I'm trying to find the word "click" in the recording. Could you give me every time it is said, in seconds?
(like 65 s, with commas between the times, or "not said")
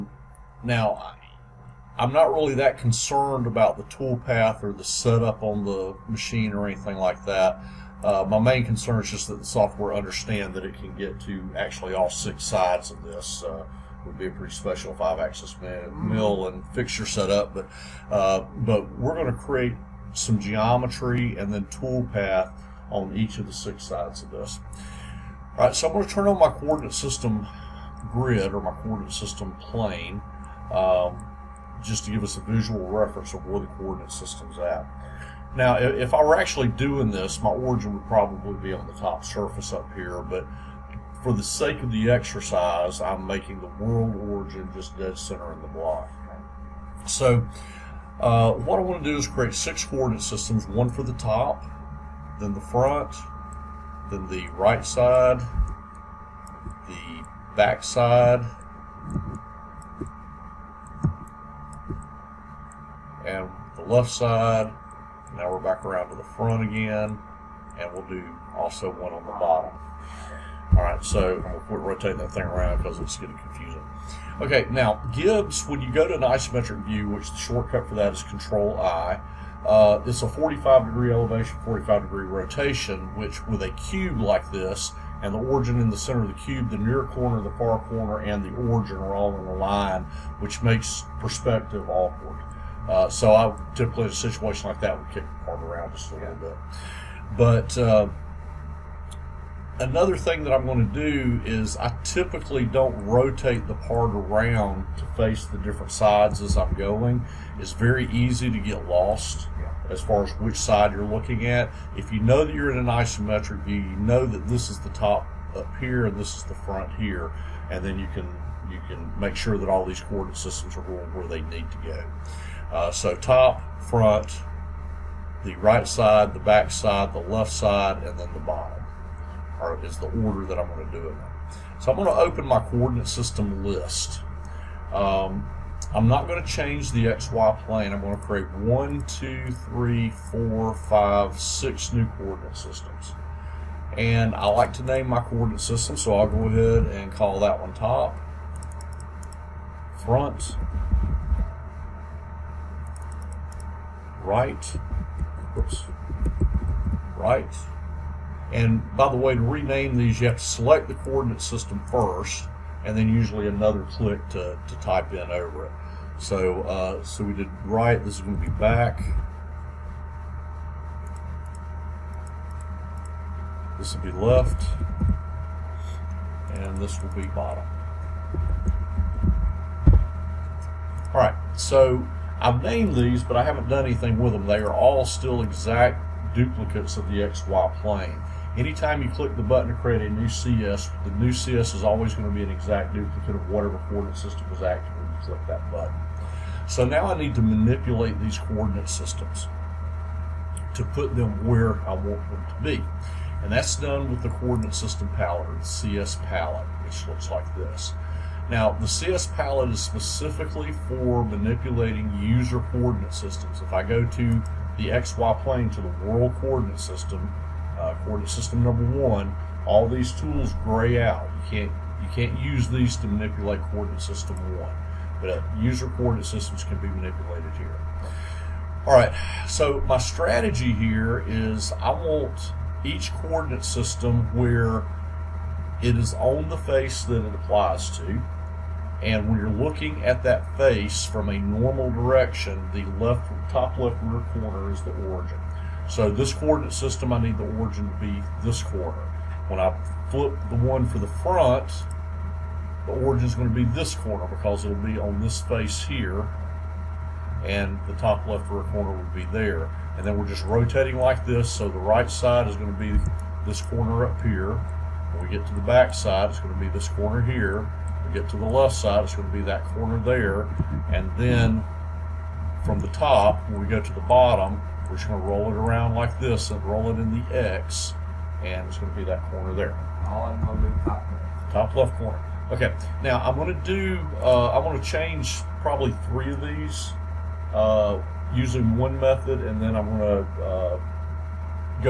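163 s, 189 s, 195 s.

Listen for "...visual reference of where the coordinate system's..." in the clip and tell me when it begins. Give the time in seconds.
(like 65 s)
32 s.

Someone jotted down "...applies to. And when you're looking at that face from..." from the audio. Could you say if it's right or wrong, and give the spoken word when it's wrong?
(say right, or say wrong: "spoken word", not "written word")
right.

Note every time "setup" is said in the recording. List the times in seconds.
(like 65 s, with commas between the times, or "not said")
4 s, 17 s.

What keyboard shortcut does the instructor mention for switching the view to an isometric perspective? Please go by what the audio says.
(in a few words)
Control I.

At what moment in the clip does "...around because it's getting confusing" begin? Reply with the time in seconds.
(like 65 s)
72 s.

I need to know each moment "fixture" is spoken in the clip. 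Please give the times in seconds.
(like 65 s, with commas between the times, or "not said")
16 s.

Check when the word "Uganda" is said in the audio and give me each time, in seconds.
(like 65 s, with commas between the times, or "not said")
not said.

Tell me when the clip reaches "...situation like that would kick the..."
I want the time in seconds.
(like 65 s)
94 s.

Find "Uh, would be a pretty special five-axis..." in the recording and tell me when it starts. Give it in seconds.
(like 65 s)
13 s.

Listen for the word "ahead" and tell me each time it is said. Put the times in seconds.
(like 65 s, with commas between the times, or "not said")
146 s.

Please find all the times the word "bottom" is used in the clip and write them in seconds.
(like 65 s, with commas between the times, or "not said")
69 s, 128 s, 177 s, 274 s.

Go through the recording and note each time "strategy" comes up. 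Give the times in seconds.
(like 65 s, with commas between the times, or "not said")
229 s.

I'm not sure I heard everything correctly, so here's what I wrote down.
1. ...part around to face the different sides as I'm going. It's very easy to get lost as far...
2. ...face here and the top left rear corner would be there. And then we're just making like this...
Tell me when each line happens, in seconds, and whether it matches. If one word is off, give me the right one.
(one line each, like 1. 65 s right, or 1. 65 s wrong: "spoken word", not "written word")
1. 103 s right
2. 255 s wrong: "rotating", not "making".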